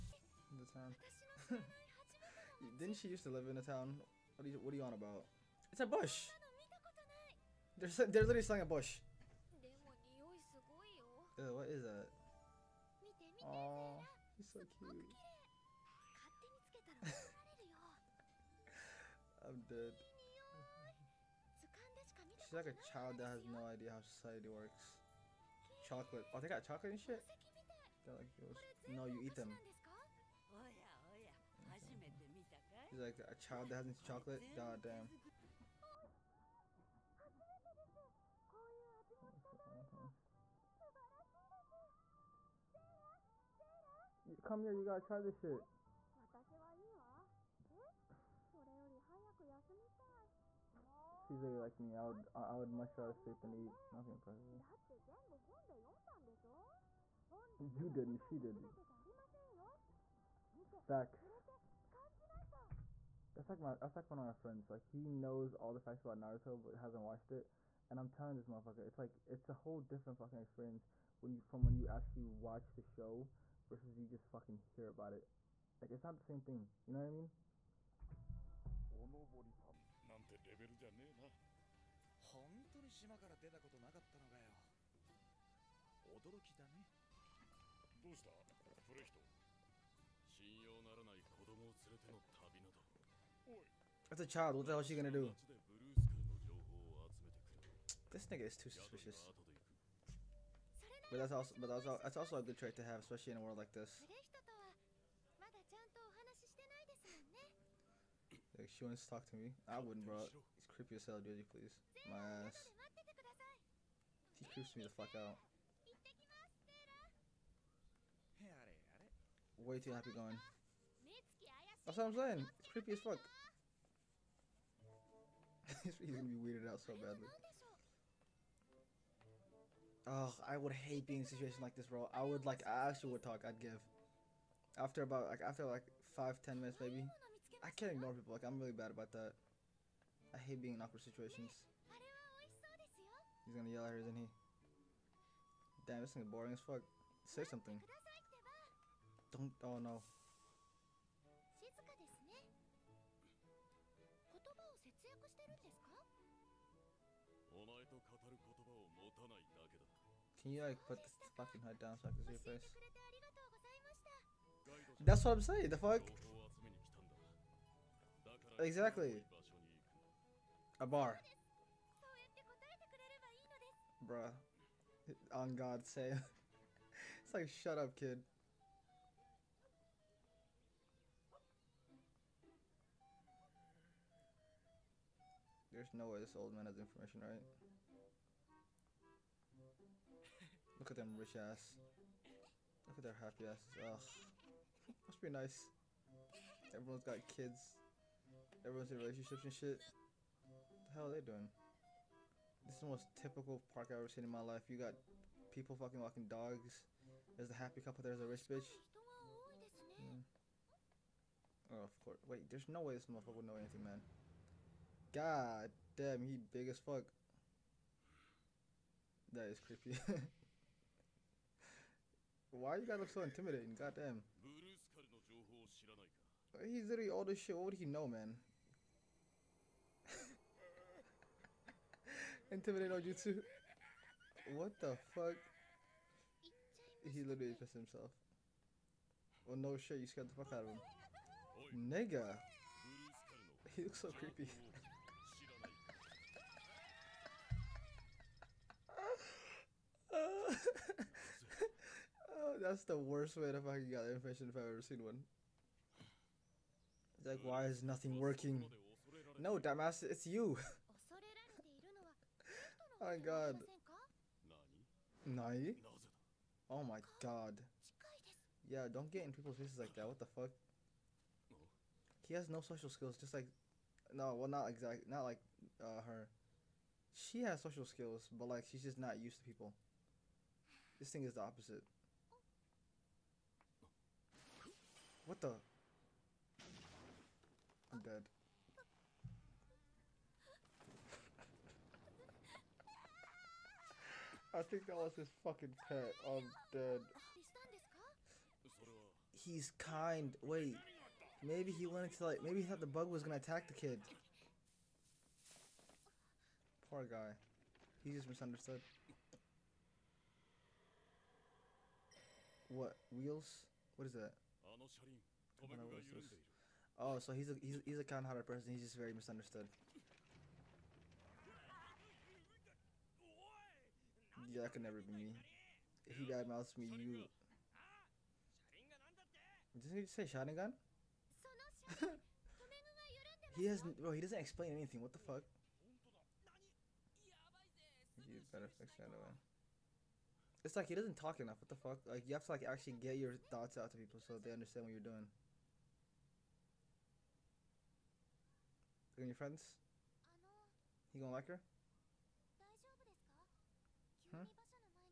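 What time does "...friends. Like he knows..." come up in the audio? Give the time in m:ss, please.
1:04.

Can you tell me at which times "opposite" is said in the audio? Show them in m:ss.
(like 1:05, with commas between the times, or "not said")
4:41.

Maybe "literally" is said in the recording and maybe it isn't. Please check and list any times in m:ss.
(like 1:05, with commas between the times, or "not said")
0:08, 0:51, 3:46, 3:57.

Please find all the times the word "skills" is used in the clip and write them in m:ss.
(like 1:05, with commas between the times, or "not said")
4:32, 4:37.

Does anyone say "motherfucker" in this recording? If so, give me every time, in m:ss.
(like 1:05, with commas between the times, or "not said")
1:08, 3:33.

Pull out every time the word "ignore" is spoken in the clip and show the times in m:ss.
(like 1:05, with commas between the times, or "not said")
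2:17.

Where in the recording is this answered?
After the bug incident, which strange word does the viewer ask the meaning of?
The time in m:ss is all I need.
5:13.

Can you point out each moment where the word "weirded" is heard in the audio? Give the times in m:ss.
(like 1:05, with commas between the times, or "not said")
2:06.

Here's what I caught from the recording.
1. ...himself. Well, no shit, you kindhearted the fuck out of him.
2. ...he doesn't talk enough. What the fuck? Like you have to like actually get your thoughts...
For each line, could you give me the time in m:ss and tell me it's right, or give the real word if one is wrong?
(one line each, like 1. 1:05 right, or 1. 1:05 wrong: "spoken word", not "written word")
1. 3:57 wrong: "scared", not "kindhearted"
2. 5:40 right.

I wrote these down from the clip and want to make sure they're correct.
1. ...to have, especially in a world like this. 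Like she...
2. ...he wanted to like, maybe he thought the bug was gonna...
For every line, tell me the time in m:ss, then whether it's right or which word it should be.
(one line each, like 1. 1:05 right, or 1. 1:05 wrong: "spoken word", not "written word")
1. 1:42 right
2. 5:01 right.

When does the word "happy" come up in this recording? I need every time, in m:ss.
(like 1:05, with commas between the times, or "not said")
1:59, 3:13, 3:27.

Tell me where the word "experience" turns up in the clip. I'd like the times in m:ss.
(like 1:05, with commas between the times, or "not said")
1:10.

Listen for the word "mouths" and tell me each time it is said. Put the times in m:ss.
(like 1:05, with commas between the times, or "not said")
5:26.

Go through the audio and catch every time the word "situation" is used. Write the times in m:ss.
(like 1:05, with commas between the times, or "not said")
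2:11, 2:21.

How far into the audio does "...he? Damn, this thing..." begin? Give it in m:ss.
2:24.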